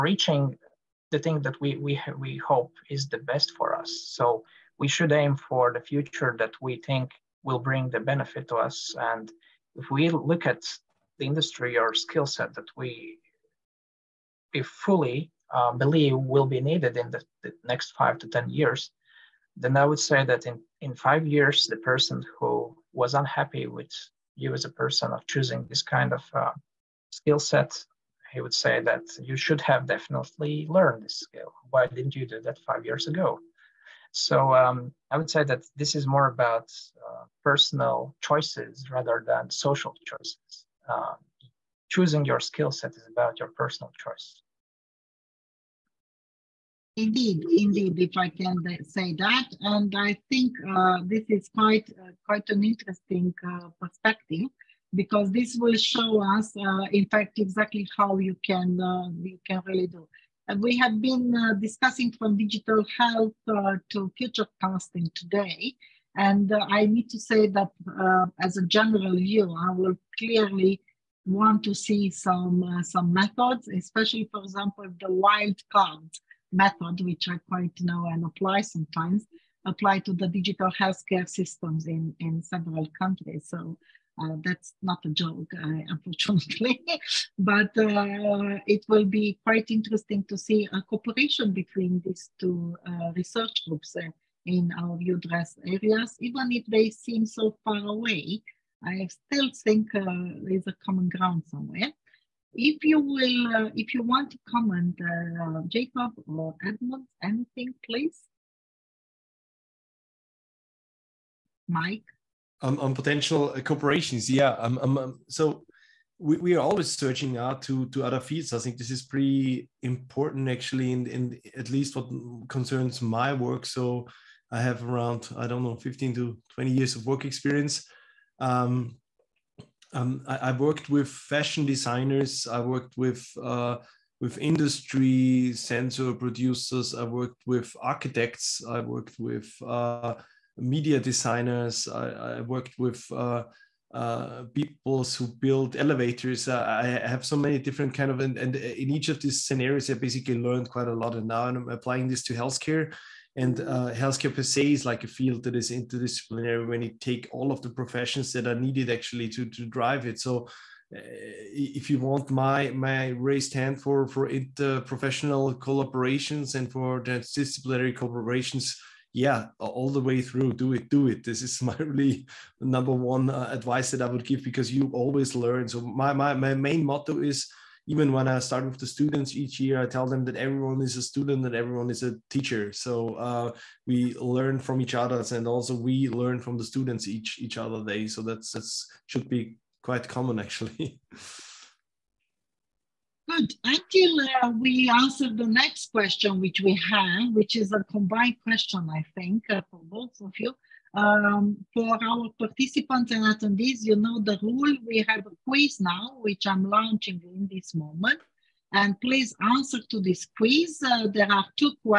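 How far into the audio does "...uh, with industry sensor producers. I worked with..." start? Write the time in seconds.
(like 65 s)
133 s.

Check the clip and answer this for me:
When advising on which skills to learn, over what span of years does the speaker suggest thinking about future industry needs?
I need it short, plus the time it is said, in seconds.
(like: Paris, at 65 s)
5 to 10 years, at 17 s.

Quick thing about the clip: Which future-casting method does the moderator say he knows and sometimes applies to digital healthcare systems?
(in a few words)
wild cards method.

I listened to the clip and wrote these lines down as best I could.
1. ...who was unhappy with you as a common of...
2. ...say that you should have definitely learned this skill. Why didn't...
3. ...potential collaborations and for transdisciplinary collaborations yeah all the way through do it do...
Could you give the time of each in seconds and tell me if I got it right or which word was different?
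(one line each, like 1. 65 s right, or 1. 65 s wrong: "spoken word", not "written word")
1. 22 s wrong: "person", not "common"
2. 28 s right
3. 164 s wrong: "interprofessional", not "potential".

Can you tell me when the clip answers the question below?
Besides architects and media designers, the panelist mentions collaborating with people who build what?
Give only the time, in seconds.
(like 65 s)
145 s.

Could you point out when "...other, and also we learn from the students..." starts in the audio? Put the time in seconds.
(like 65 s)
184 s.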